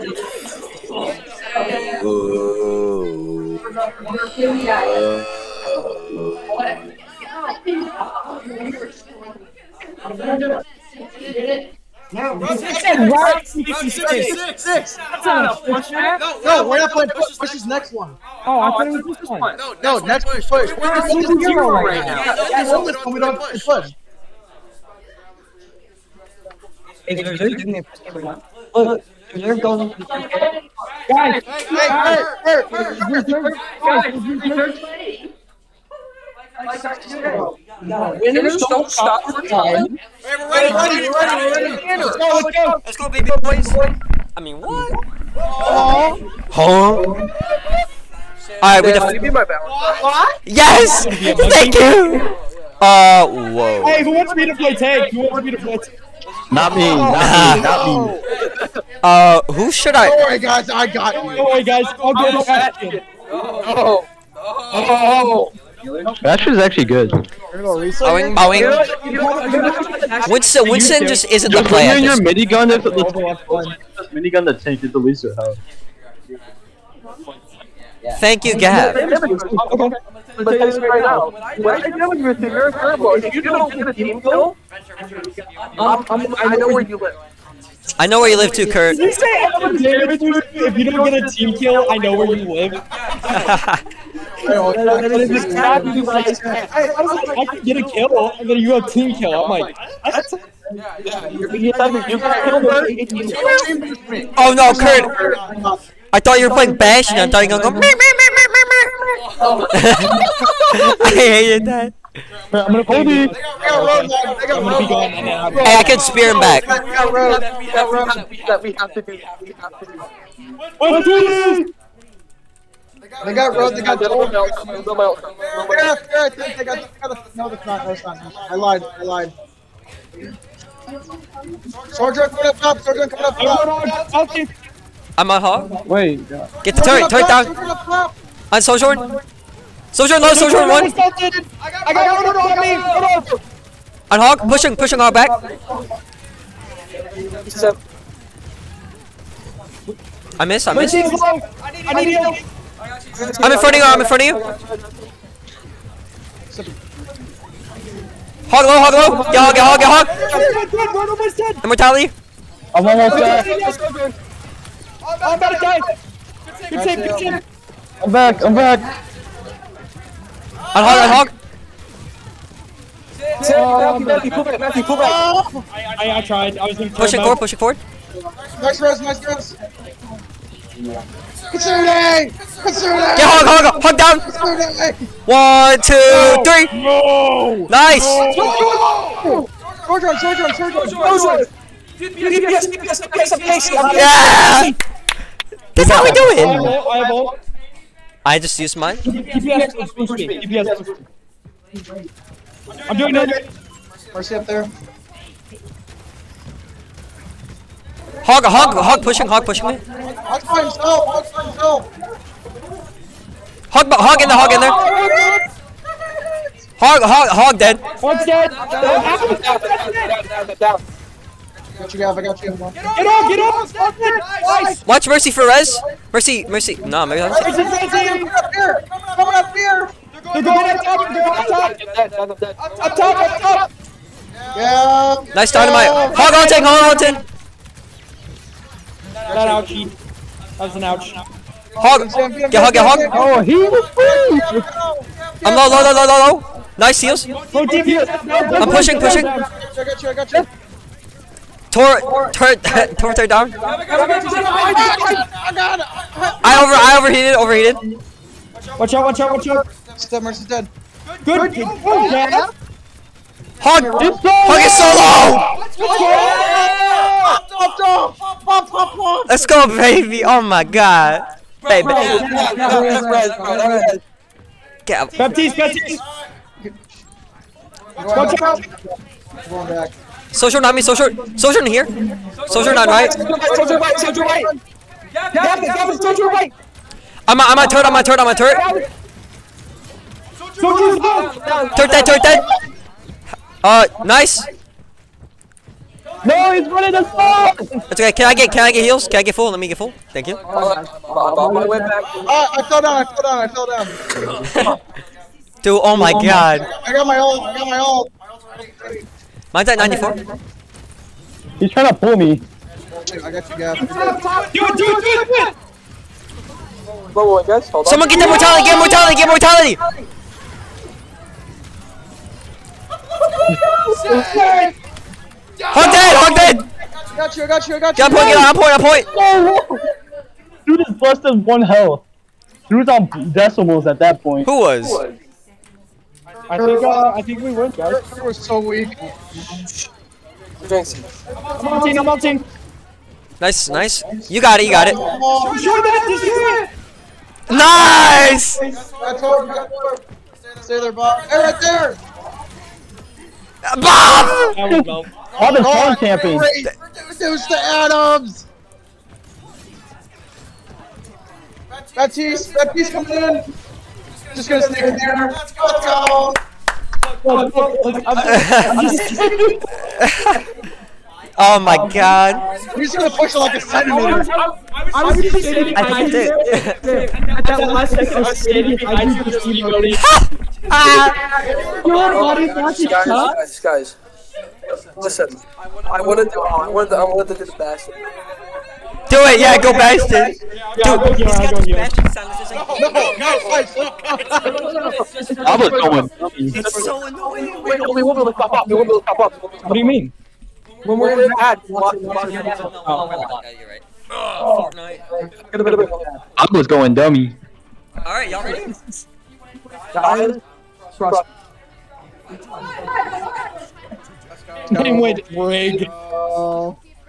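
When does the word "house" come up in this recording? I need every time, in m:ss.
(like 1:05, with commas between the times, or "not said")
1:15.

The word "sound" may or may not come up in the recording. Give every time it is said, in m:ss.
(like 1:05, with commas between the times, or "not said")
6:32.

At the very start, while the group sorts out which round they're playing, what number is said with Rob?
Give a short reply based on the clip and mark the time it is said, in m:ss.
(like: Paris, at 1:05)
66, at 0:13.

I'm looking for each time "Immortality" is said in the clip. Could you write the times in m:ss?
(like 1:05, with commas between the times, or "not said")
2:41.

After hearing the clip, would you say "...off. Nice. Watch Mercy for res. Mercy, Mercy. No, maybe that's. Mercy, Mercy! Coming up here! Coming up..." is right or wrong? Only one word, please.
right.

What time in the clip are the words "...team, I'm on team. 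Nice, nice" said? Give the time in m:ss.
5:41.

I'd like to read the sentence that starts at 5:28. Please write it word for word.
Get Got point, get on, point, on point.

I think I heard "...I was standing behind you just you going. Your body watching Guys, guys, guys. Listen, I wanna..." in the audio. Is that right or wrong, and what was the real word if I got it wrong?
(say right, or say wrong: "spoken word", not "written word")
right.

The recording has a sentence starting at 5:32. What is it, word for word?
Dude's on decimals at that point.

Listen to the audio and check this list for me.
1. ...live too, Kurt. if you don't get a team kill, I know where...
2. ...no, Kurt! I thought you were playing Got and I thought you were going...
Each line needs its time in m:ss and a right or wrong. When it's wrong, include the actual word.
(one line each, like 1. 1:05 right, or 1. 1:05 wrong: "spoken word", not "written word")
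1. 1:28 right
2. 1:44 wrong: "Bash", not "Got".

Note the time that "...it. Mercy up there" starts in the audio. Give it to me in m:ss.
3:23.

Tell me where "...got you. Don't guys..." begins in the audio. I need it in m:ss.
1:00.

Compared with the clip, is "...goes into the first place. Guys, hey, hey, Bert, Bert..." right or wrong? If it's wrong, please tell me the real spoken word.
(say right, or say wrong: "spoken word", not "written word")
right.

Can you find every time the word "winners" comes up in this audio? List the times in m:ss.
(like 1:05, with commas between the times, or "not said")
0:38.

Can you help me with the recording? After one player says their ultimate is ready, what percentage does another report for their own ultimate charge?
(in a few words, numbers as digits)
94.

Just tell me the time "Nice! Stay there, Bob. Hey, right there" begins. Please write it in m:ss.
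5:47.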